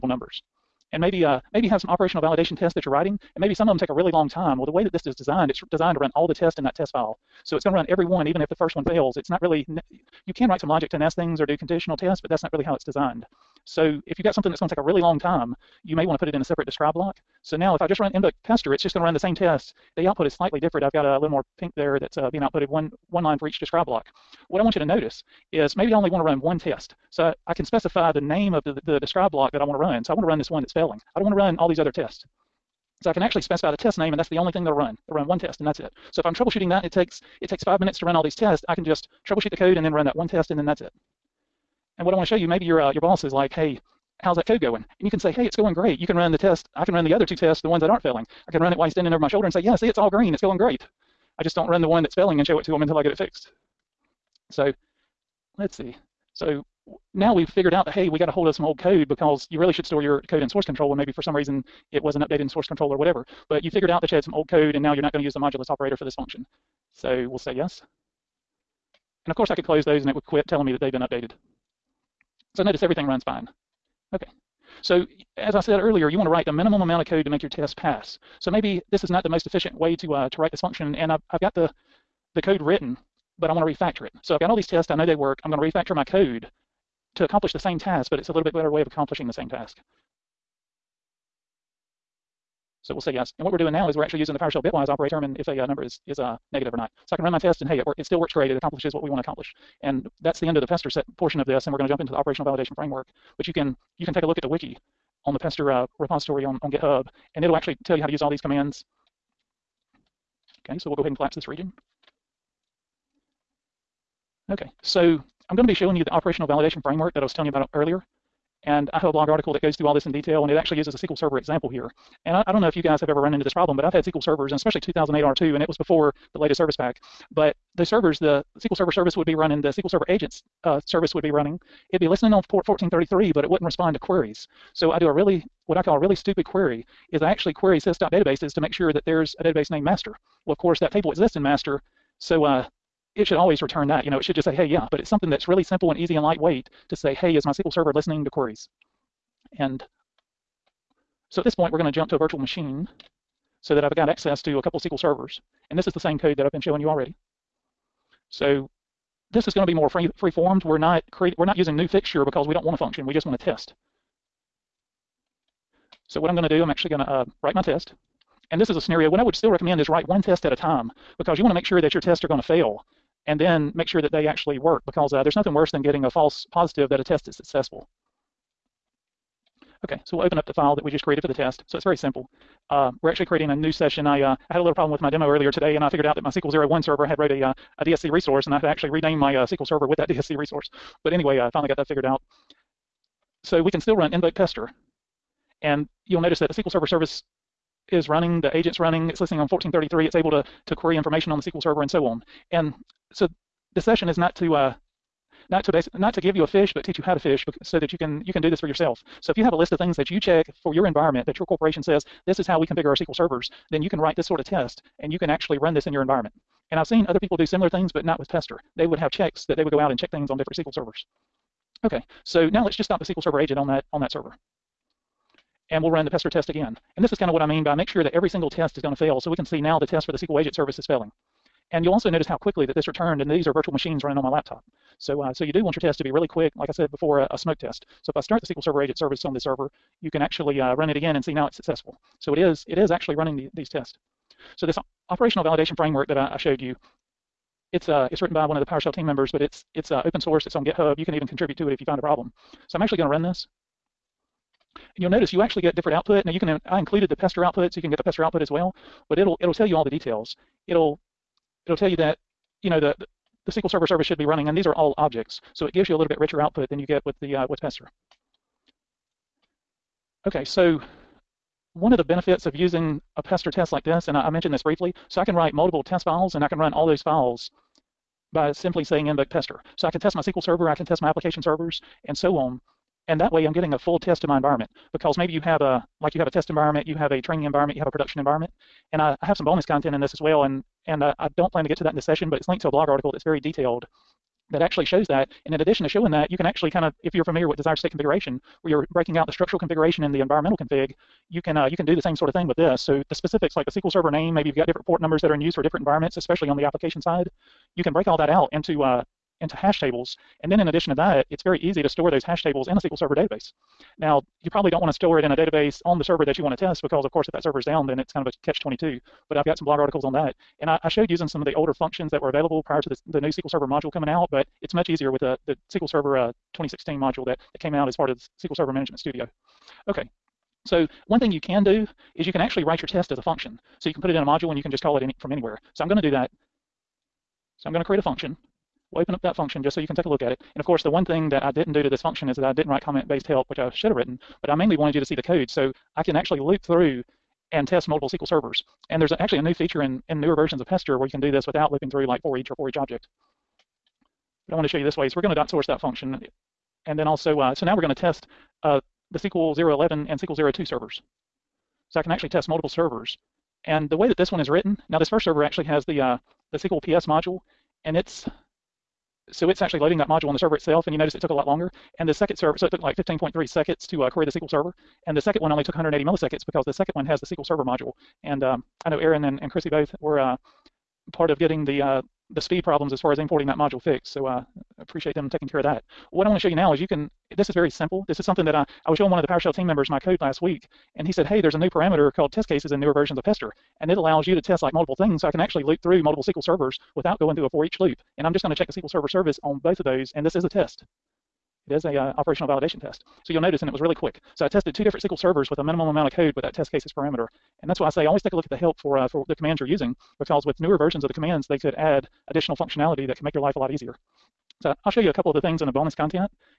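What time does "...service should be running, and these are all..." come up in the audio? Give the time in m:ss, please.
4:23.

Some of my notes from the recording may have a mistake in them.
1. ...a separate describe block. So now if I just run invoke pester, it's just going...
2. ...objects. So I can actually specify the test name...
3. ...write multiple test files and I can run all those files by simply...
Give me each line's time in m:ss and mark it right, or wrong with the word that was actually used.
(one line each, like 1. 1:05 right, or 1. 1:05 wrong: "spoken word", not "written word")
1. 0:16 right
2. 0:31 wrong: "tests", not "objects"
3. 4:35 right.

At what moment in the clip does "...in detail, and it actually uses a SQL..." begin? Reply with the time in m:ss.
2:00.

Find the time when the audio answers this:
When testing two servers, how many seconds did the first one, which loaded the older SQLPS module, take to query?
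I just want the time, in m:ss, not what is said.
6:12.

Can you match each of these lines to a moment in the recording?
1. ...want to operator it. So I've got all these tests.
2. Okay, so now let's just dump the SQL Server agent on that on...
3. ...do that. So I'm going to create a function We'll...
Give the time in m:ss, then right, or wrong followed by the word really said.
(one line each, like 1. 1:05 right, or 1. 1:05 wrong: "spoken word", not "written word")
1. 1:23 wrong: "refactor", not "operator"
2. 3:41 right
3. 5:36 right.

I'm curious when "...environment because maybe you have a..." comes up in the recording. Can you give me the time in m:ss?
4:44.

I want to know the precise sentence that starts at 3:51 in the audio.
And you'll also notice how quickly that this returned, and these are virtual machines running on my laptop.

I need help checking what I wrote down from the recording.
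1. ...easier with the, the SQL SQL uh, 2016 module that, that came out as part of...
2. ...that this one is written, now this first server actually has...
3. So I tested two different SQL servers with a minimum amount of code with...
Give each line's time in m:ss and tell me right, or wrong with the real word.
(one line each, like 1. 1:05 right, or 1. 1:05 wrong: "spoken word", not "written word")
1. 5:24 wrong: "Server", not "SQL"
2. 6:04 right
3. 6:44 right.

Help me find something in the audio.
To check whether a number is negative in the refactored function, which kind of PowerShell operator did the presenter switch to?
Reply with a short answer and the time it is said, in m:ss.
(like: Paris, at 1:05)
bitwise operator, at 1:34.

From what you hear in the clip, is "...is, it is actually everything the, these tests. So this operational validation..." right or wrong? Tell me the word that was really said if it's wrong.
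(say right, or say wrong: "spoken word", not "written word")
wrong: "running", not "everything".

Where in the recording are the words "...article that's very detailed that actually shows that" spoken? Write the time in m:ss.
4:52.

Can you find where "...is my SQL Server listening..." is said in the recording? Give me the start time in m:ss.
2:27.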